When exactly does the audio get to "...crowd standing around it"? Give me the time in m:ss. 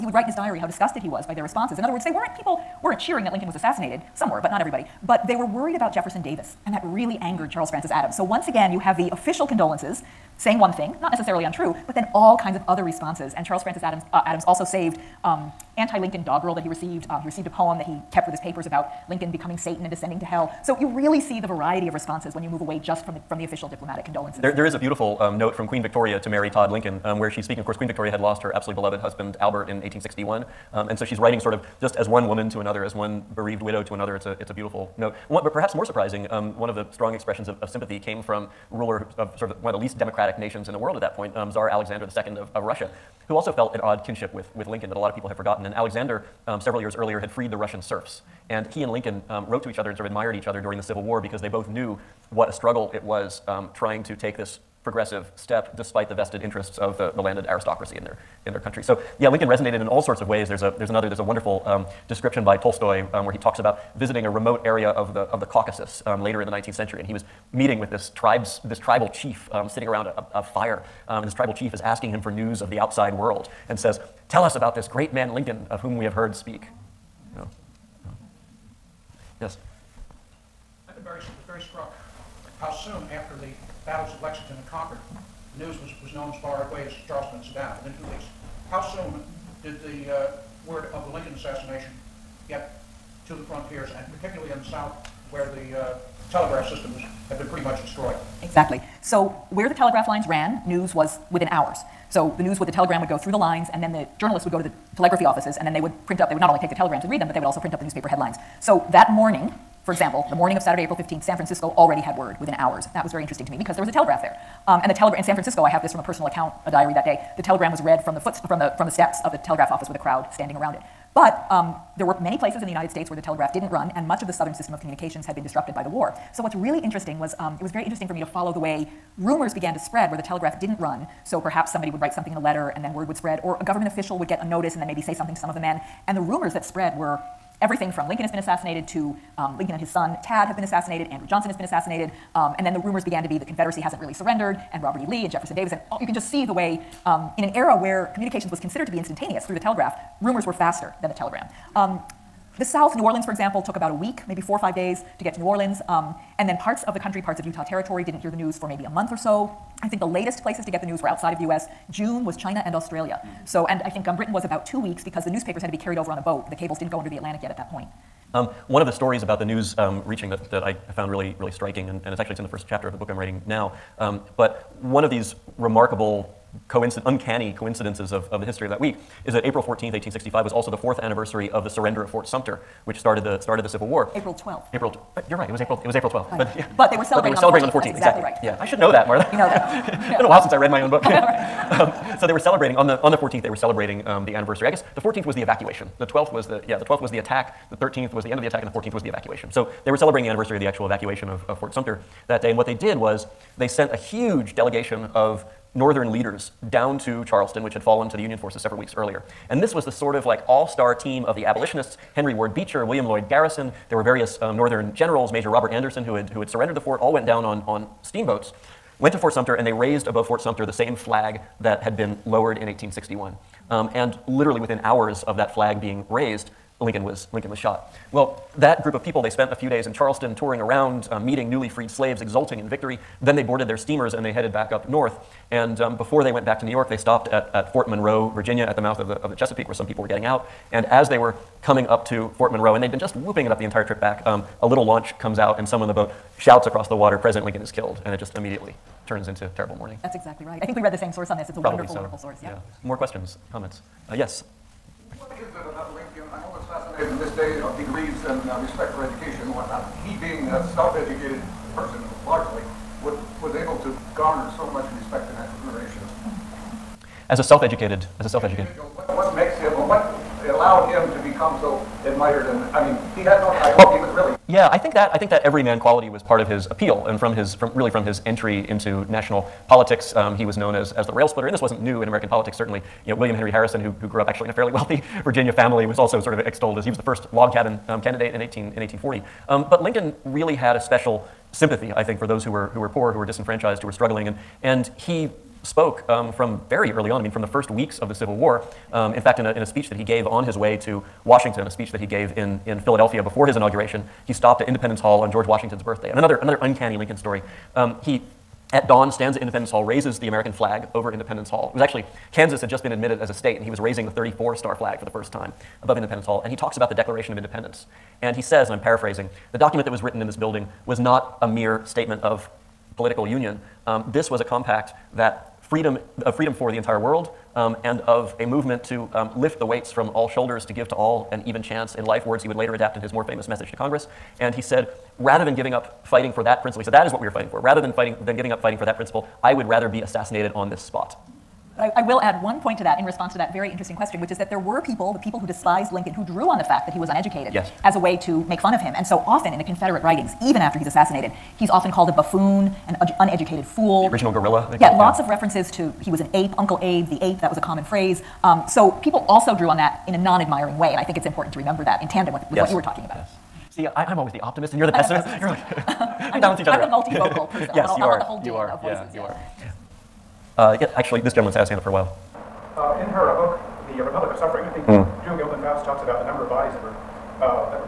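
1:59.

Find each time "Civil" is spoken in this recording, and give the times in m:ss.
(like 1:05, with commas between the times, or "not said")
0:50, 3:03, 4:58.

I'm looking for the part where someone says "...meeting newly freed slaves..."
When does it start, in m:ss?
3:51.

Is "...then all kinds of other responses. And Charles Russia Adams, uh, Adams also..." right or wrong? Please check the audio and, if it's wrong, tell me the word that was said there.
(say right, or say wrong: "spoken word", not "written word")
wrong: "Francis", not "Russia".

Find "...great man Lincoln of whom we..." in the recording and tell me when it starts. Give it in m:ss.
1:14.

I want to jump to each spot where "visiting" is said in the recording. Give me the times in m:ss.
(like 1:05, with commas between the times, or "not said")
1:03.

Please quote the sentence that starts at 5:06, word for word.
And another, another uncanny Lincoln story.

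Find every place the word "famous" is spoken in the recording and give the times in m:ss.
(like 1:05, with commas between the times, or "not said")
5:33.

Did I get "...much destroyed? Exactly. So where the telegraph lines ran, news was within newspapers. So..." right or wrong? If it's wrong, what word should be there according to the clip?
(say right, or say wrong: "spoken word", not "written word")
wrong: "hours", not "newspapers".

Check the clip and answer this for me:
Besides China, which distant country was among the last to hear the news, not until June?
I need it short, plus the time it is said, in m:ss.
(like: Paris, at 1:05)
Australia, at 2:42.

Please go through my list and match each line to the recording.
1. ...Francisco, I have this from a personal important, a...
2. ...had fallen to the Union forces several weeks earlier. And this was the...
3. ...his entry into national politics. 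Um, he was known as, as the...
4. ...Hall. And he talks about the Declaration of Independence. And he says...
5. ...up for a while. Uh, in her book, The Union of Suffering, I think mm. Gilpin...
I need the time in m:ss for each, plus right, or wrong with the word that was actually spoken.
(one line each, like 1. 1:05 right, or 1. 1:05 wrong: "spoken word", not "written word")
1. 1:55 wrong: "account", not "important"
2. 3:27 right
3. 4:38 right
4. 5:16 right
5. 6:11 wrong: "Republic", not "Union".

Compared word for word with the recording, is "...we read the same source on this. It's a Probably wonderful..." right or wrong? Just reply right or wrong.
right.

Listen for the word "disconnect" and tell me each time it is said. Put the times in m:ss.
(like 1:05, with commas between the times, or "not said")
not said.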